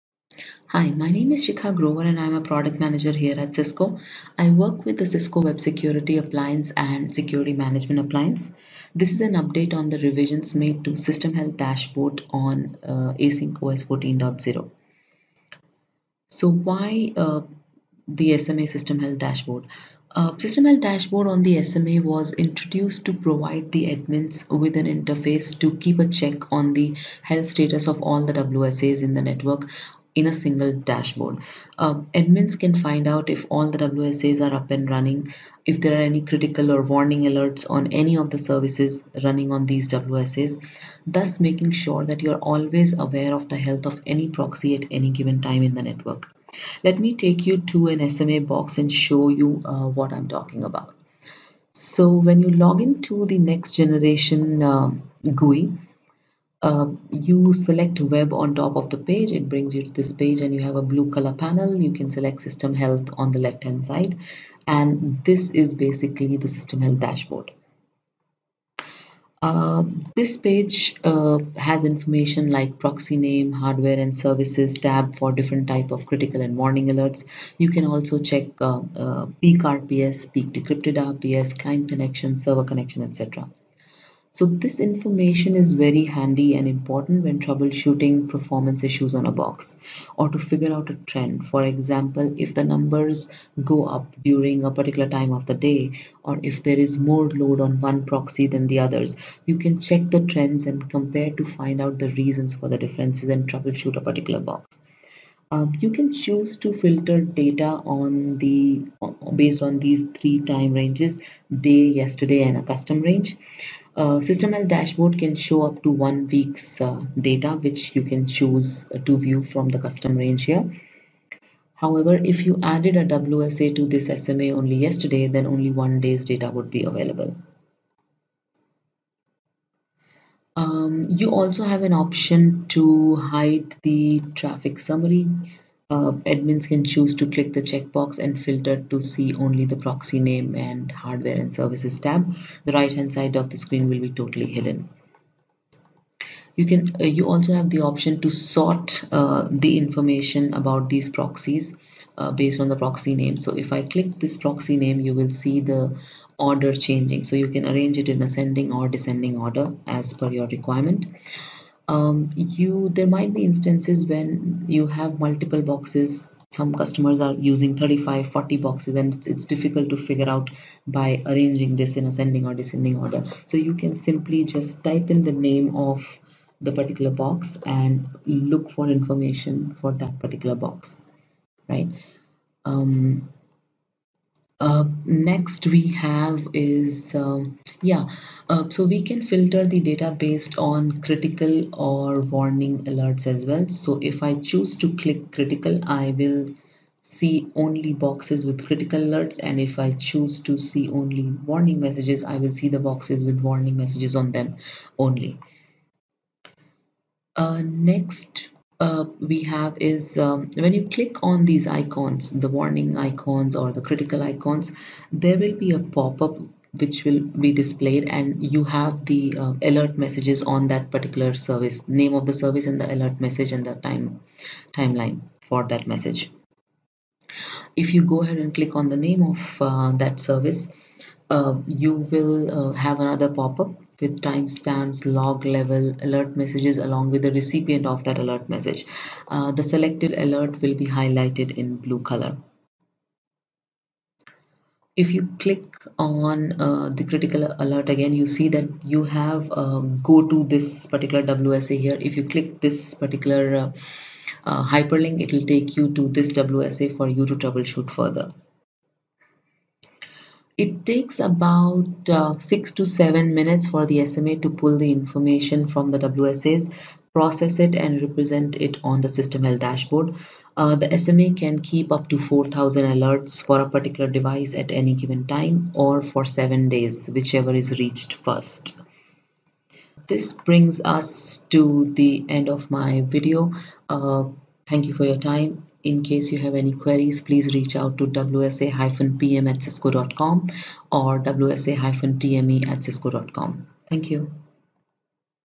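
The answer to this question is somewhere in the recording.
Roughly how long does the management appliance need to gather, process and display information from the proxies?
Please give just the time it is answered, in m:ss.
4:22.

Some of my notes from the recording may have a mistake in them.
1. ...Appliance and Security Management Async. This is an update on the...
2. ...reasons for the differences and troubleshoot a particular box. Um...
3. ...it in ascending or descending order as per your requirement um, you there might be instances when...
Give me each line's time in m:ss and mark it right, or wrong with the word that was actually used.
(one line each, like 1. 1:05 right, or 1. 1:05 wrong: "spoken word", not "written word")
1. 0:06 wrong: "Appliance", not "Async"
2. 1:42 right
3. 2:37 right.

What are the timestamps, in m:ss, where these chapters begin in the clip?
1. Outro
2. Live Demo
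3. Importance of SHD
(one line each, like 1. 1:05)
1. 4:41
2. 0:48
3. 0:14.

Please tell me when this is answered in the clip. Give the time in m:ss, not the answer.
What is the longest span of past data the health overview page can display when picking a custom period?
1:55.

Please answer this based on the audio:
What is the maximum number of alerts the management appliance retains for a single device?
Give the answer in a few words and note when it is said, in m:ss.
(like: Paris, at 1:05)
4,000, at 4:32.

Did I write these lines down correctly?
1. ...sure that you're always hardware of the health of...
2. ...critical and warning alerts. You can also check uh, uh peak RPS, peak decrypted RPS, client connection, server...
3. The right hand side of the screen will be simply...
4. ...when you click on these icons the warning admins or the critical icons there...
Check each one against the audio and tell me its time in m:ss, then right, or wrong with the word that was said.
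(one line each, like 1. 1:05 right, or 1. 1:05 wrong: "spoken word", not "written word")
1. 0:41 wrong: "aware", not "hardware"
2. 1:16 right
3. 2:22 wrong: "totally", not "simply"
4. 3:30 wrong: "icons", not "admins".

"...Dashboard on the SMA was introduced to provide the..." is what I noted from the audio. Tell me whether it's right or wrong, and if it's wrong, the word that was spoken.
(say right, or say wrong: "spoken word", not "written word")
right.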